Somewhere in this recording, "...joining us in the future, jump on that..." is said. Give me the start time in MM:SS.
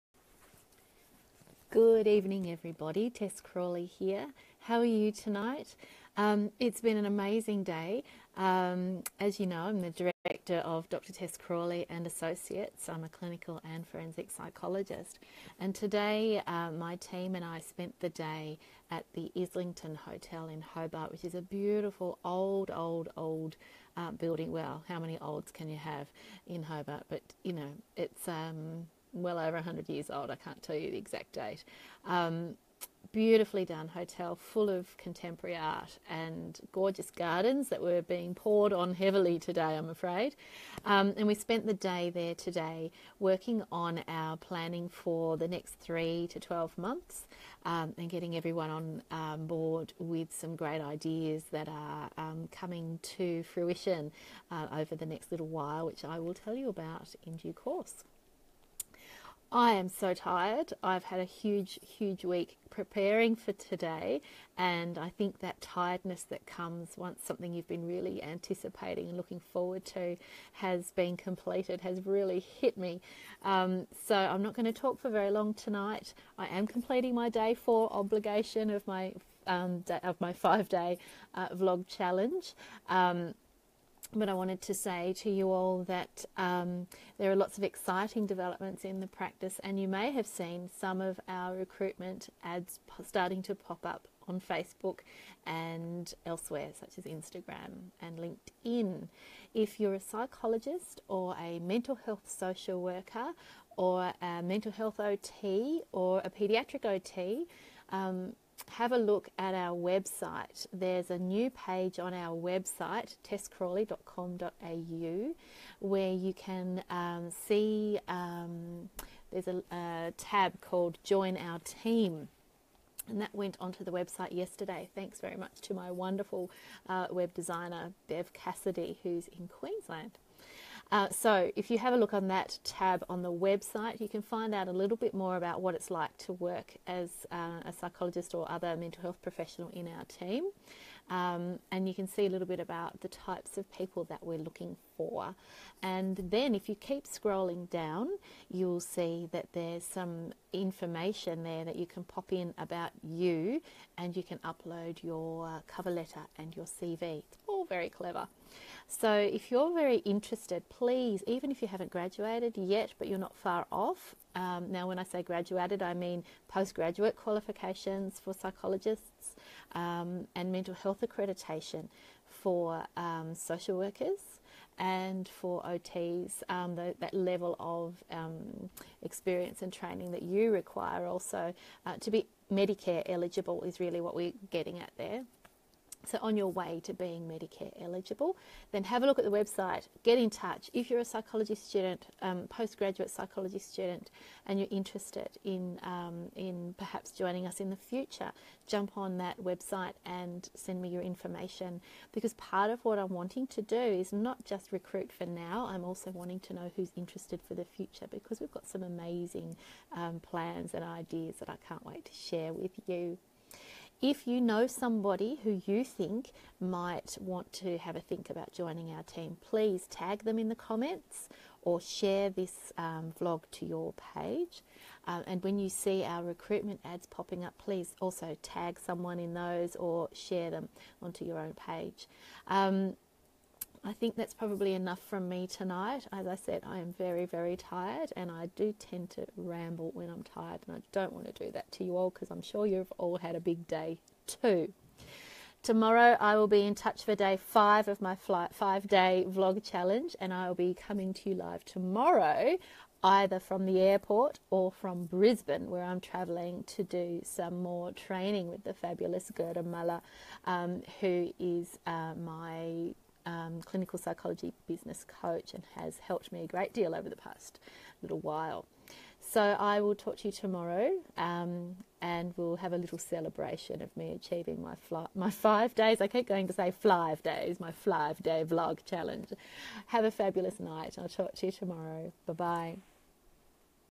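03:17.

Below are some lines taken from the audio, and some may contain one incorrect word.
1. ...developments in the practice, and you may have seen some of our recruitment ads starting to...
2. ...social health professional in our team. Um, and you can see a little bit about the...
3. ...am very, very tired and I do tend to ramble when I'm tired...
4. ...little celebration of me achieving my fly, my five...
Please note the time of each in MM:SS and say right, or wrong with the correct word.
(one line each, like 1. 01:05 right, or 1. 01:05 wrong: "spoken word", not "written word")
1. 01:28 right
2. 02:18 wrong: "mental", not "social"
3. 03:56 right
4. 04:32 right.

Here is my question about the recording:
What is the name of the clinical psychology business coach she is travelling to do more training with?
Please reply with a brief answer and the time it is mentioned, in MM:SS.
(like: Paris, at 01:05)
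Gerda Muller, at 04:19.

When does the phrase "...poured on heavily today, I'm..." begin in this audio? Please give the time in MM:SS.
00:38.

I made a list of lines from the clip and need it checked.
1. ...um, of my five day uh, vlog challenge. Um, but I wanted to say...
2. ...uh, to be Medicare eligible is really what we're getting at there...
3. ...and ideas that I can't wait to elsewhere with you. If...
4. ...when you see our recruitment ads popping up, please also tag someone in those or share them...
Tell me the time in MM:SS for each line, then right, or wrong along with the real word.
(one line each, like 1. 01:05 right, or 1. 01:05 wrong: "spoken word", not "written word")
1. 01:19 right
2. 03:01 right
3. 03:30 wrong: "share", not "elsewhere"
4. 03:45 right.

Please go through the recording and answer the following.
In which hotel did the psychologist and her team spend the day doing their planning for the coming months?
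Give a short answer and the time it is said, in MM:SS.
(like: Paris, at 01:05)
Islington Hotel, at 00:19.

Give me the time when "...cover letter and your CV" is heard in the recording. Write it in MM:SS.
02:35.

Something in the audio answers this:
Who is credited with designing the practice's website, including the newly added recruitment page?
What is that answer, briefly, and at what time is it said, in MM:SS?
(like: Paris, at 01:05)
Bev Cassidy, at 02:08.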